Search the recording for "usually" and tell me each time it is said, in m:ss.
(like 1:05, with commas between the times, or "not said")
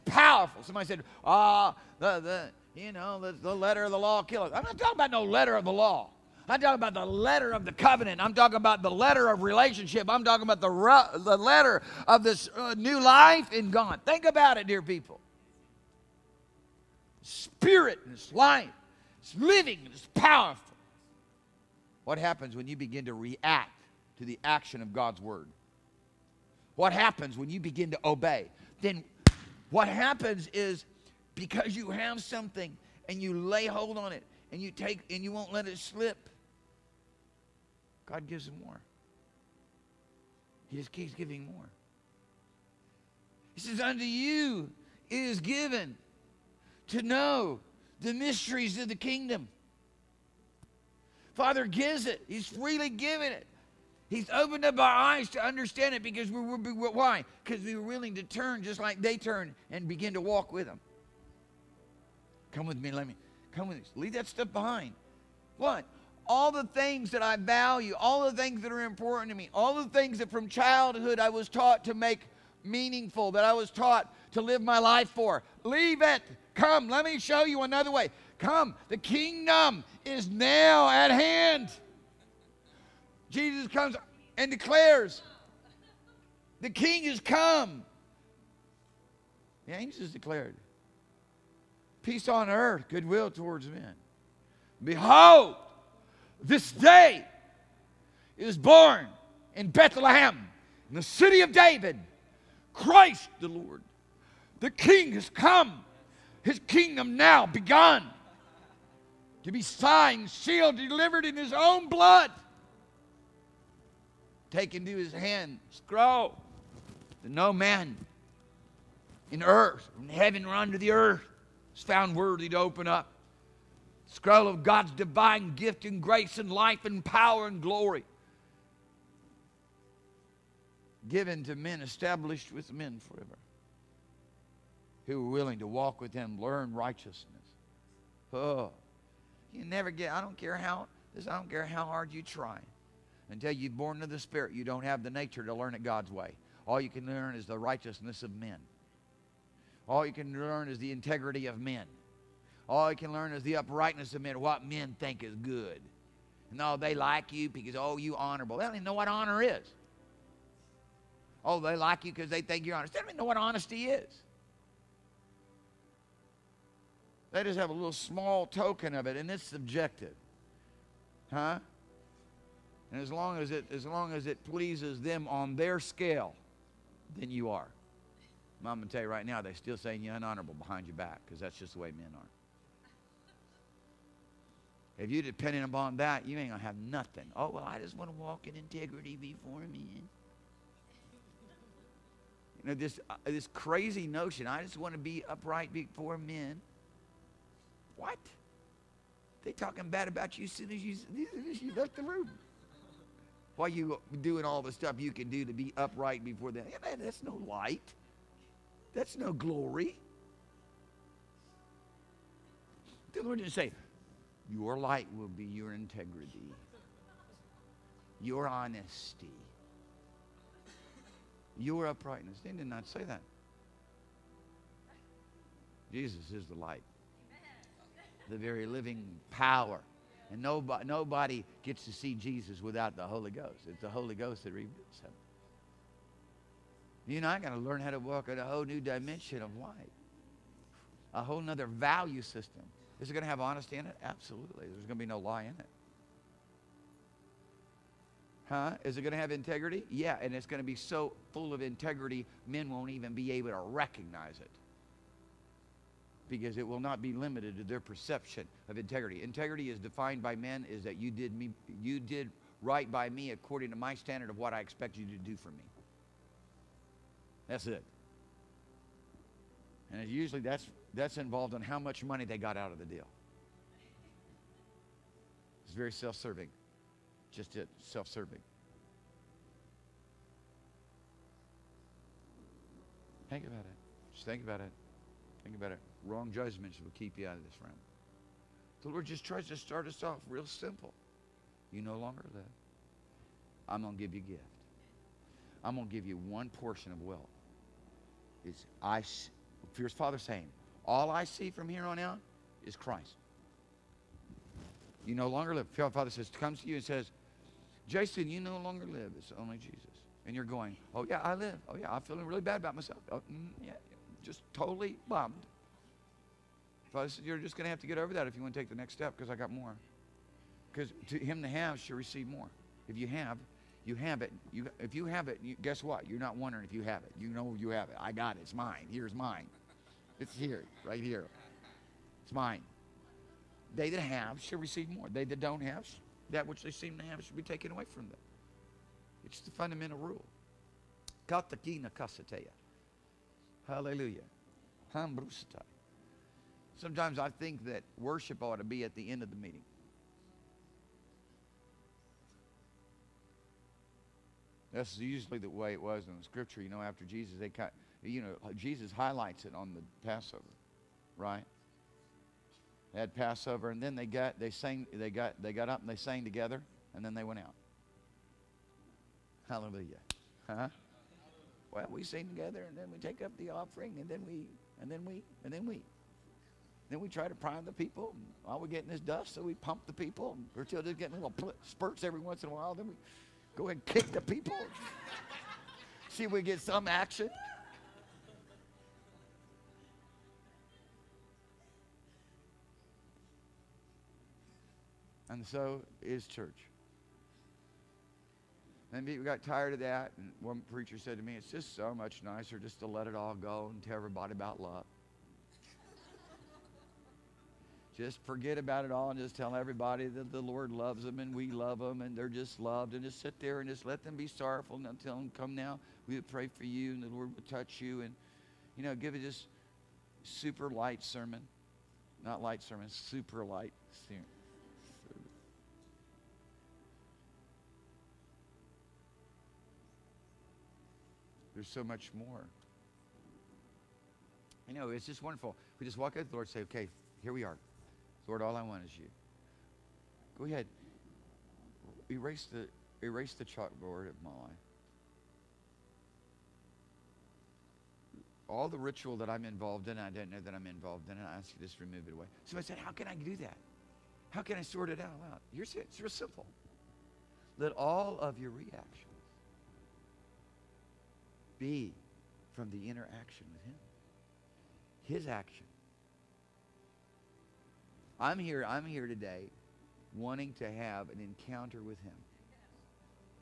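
4:30, 5:54.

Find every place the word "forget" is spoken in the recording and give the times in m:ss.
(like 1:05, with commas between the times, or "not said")
6:48.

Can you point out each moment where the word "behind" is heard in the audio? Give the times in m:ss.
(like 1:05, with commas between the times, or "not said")
1:04, 3:00.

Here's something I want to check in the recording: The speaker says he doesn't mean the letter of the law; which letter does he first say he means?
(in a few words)
the letter of the covenant.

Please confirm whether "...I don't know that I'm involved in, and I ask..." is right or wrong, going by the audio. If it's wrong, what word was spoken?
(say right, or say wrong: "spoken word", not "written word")
right.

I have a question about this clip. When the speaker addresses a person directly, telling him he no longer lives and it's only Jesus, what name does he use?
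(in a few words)
Jason.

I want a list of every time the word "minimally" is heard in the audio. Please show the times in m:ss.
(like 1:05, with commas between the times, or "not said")
not said.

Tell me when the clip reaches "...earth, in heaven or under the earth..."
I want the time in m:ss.
1:59.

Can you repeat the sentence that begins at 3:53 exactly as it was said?
It's the Holy Ghost that reveals him.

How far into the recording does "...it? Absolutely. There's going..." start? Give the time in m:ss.
4:03.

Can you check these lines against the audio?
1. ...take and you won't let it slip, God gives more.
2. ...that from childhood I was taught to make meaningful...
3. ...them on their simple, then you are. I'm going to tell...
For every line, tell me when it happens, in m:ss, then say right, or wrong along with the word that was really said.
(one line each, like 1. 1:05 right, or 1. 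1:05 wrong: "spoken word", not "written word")
1. 0:34 right
2. 1:10 right
3. 2:55 wrong: "scale", not "simple".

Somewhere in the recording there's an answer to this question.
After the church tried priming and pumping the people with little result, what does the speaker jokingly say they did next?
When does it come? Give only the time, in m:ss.
6:23.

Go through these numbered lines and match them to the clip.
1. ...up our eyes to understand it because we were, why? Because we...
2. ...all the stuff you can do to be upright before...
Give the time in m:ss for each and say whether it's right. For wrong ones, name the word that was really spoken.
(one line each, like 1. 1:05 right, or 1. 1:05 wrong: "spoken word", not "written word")
1. 0:54 right
2. 3:24 right.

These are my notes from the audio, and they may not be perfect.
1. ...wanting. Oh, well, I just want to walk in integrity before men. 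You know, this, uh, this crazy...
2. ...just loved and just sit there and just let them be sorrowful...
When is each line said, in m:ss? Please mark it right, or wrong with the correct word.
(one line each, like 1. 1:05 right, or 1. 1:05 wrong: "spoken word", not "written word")
1. 3:06 wrong: "nothing", not "wanting"
2. 6:52 right.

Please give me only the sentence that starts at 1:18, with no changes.
Come, the kingdom is now at hand.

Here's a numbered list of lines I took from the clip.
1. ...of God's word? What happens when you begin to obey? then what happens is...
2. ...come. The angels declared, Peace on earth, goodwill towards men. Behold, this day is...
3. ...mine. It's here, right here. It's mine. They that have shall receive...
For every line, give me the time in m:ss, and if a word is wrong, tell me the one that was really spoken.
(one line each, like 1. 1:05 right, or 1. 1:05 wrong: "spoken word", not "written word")
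1. 0:24 right
2. 1:27 right
3. 5:29 right.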